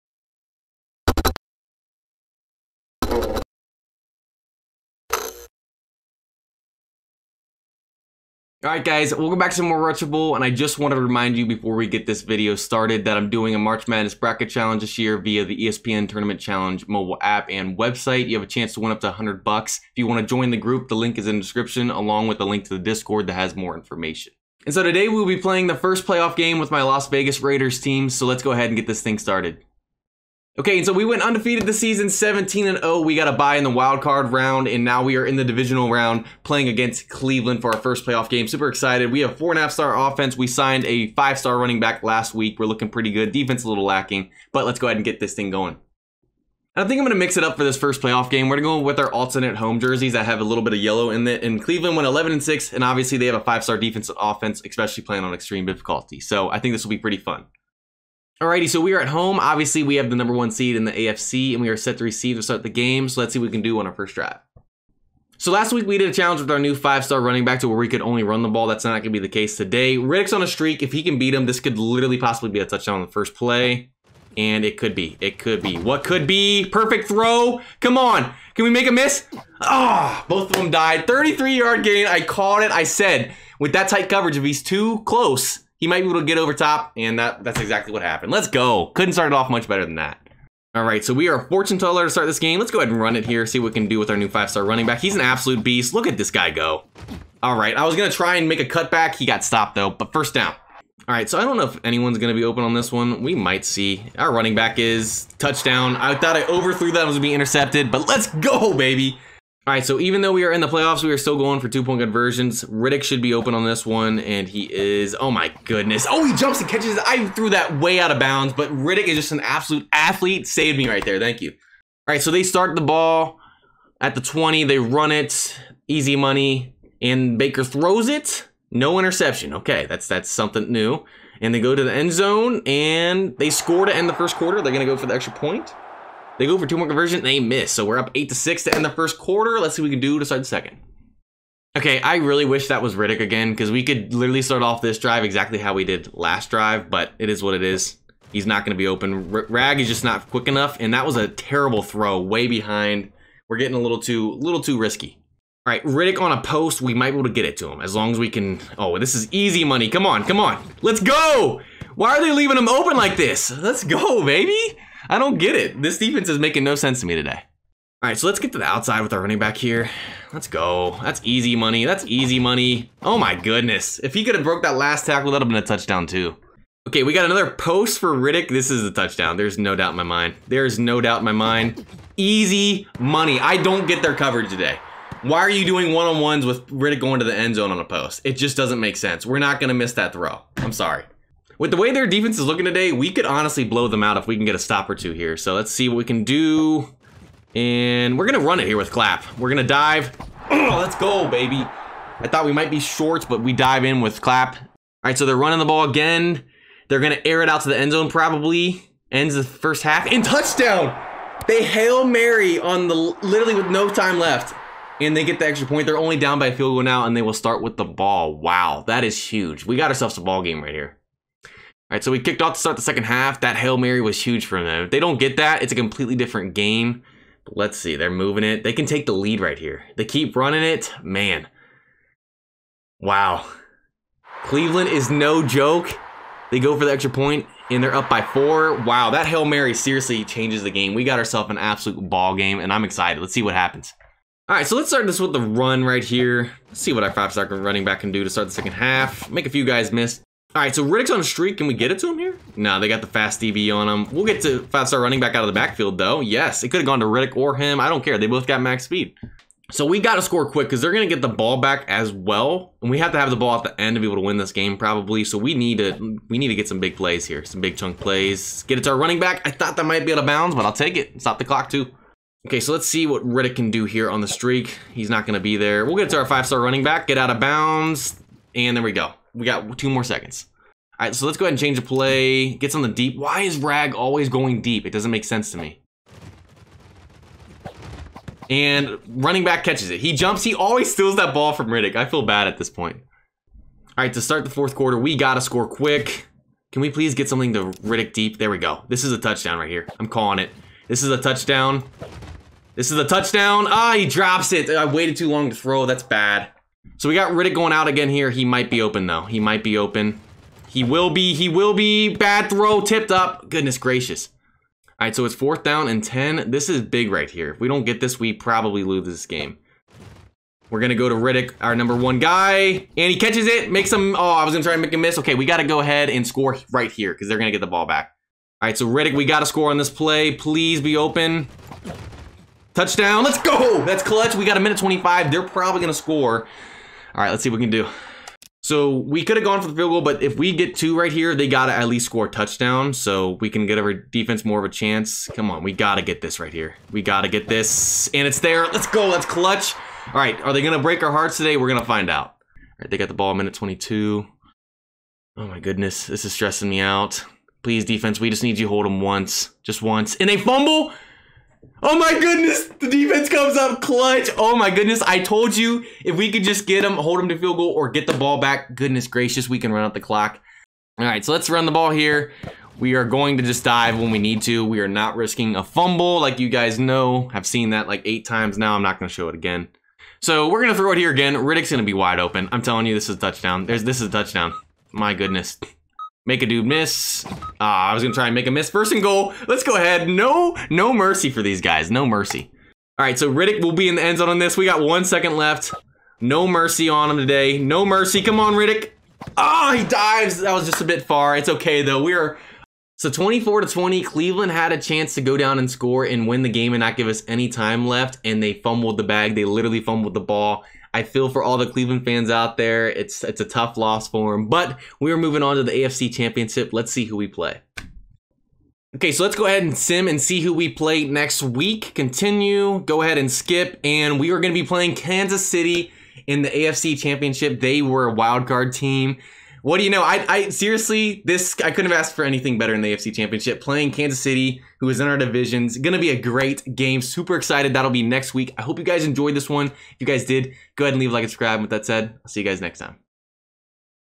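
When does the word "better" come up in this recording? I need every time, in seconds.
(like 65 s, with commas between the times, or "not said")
89 s, 432 s.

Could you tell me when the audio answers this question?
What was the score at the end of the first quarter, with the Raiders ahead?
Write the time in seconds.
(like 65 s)
138 s.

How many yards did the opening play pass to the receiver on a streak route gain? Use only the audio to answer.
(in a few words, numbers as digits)
33.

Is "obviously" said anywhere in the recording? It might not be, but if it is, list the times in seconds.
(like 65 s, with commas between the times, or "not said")
52 s, 59 s.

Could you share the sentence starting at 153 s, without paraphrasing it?
We're getting a little too, little too risky.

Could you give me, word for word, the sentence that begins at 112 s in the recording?
Riddick should be open on this one, and he is.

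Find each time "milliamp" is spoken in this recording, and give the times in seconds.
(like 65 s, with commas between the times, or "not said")
not said.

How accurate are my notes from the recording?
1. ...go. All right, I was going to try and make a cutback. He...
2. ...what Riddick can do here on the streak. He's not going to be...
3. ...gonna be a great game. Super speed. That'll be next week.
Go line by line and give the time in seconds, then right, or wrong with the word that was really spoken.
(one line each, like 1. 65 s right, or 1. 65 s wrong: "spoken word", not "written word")
1. 96 s right
2. 273 s right
3. 435 s wrong: "excited", not "speed".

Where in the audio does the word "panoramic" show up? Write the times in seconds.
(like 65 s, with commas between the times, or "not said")
not said.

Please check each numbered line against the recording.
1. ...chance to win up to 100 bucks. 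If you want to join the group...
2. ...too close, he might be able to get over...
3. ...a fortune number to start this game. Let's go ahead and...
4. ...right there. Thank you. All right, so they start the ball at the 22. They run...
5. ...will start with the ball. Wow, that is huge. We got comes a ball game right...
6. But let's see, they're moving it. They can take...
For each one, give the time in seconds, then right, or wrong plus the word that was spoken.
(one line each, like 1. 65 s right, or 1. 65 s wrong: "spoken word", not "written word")
1. 18 s right
2. 84 s right
3. 91 s wrong: "teller", not "number"
4. 120 s wrong: "20", not "22"
5. 217 s wrong: "ourselves", not "comes"
6. 227 s right.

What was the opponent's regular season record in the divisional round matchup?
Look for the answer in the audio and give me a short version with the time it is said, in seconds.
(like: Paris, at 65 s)
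11-6, at 52 s.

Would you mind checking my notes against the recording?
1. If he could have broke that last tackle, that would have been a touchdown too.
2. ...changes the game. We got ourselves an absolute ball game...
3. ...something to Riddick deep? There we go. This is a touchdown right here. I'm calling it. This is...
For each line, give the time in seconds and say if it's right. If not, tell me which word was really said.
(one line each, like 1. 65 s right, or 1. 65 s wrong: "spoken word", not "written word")
1. 173 s right
2. 240 s right
3. 297 s right.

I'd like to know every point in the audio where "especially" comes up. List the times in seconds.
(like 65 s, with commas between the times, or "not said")
54 s.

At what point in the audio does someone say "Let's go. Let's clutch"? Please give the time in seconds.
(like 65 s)
348 s.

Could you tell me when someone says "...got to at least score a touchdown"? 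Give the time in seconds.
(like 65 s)
341 s.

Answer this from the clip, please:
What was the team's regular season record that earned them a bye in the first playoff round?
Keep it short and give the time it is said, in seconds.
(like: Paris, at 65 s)
17-0, at 32 s.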